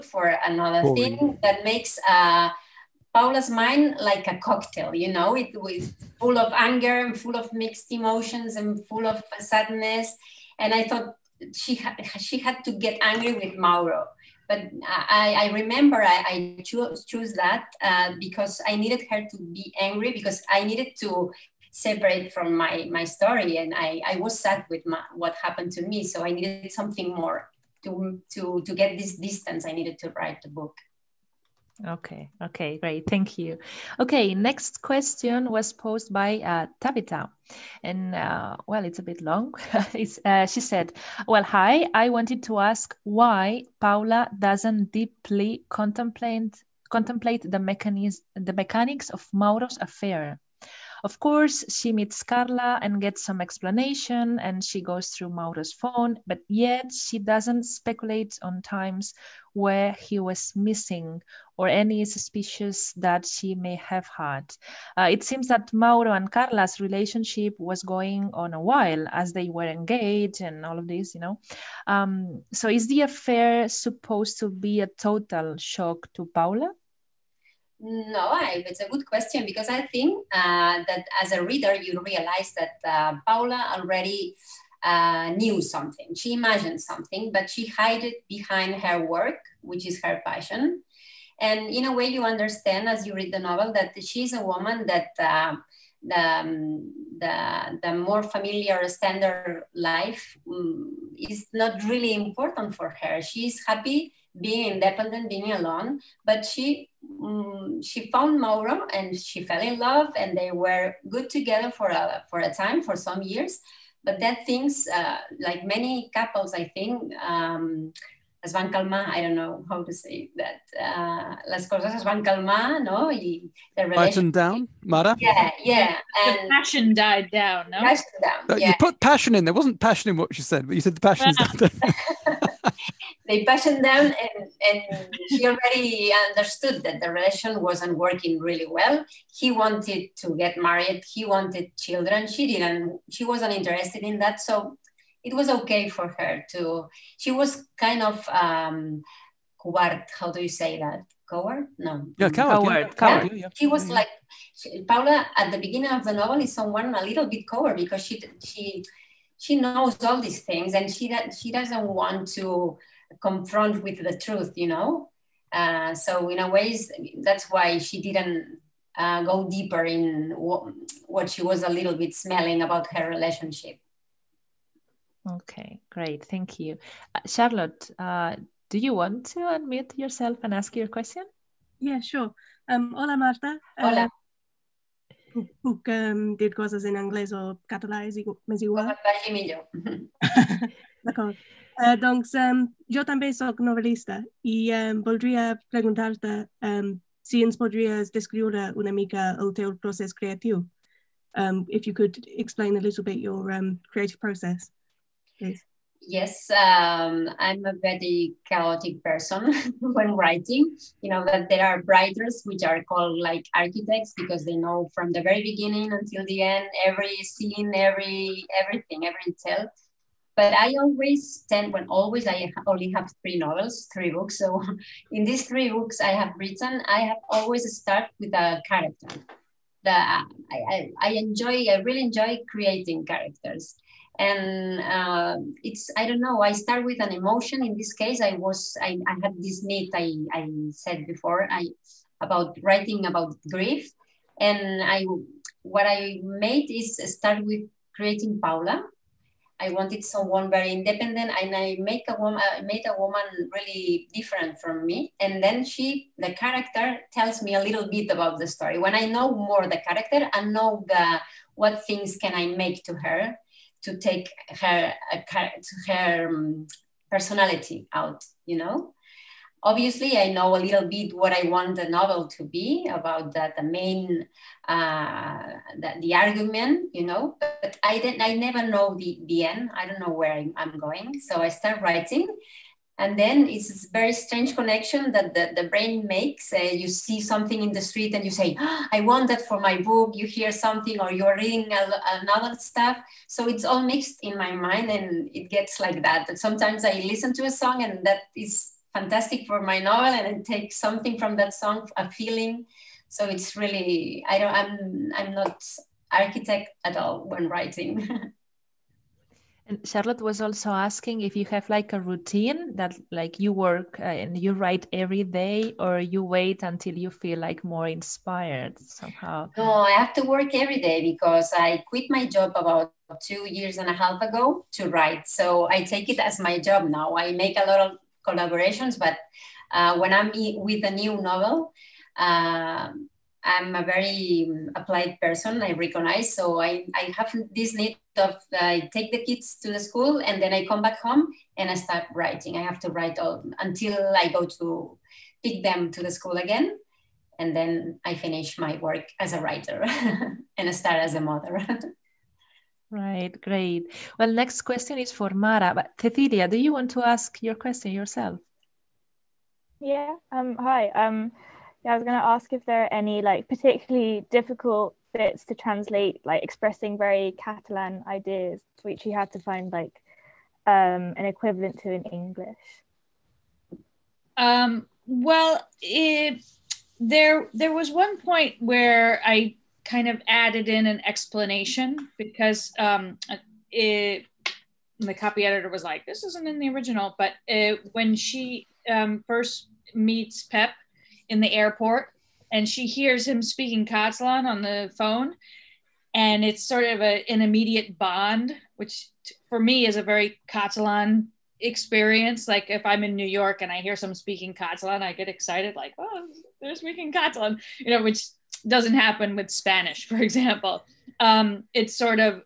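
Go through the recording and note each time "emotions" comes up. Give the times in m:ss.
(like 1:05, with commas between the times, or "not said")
0:07, 3:57.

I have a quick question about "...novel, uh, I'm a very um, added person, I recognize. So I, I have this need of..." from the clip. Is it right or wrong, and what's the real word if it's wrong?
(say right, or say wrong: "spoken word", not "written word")
wrong: "applied", not "added".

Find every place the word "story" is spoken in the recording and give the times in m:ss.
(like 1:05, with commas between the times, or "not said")
0:23, 4:18.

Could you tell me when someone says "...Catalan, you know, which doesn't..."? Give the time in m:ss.
6:47.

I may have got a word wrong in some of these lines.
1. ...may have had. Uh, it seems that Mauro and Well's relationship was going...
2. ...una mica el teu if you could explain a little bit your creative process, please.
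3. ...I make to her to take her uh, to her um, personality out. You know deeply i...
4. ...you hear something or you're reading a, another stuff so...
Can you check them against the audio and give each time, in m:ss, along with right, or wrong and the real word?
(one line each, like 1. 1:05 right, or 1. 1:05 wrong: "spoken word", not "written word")
1. 1:03 wrong: "Carla", not "Well"
2. 3:17 right
3. 4:22 wrong: "obviously", not "deeply"
4. 4:50 right.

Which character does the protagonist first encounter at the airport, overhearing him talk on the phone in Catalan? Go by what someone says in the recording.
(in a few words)
Pep.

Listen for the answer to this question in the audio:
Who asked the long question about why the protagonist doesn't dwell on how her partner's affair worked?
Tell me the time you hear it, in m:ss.
0:36.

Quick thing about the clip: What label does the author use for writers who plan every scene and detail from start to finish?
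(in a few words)
architects.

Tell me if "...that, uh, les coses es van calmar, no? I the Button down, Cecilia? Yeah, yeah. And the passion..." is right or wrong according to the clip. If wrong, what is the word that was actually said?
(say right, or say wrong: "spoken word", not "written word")
wrong: "Mara", not "Cecilia".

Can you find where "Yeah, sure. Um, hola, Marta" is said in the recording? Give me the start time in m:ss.
3:01.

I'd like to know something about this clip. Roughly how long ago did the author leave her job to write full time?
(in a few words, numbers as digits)
2 and a half years.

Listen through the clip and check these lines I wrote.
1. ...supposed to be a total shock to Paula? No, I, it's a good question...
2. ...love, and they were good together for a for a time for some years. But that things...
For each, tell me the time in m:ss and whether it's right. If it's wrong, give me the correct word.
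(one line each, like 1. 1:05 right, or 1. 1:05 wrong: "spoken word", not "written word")
1. 1:13 right
2. 1:49 right.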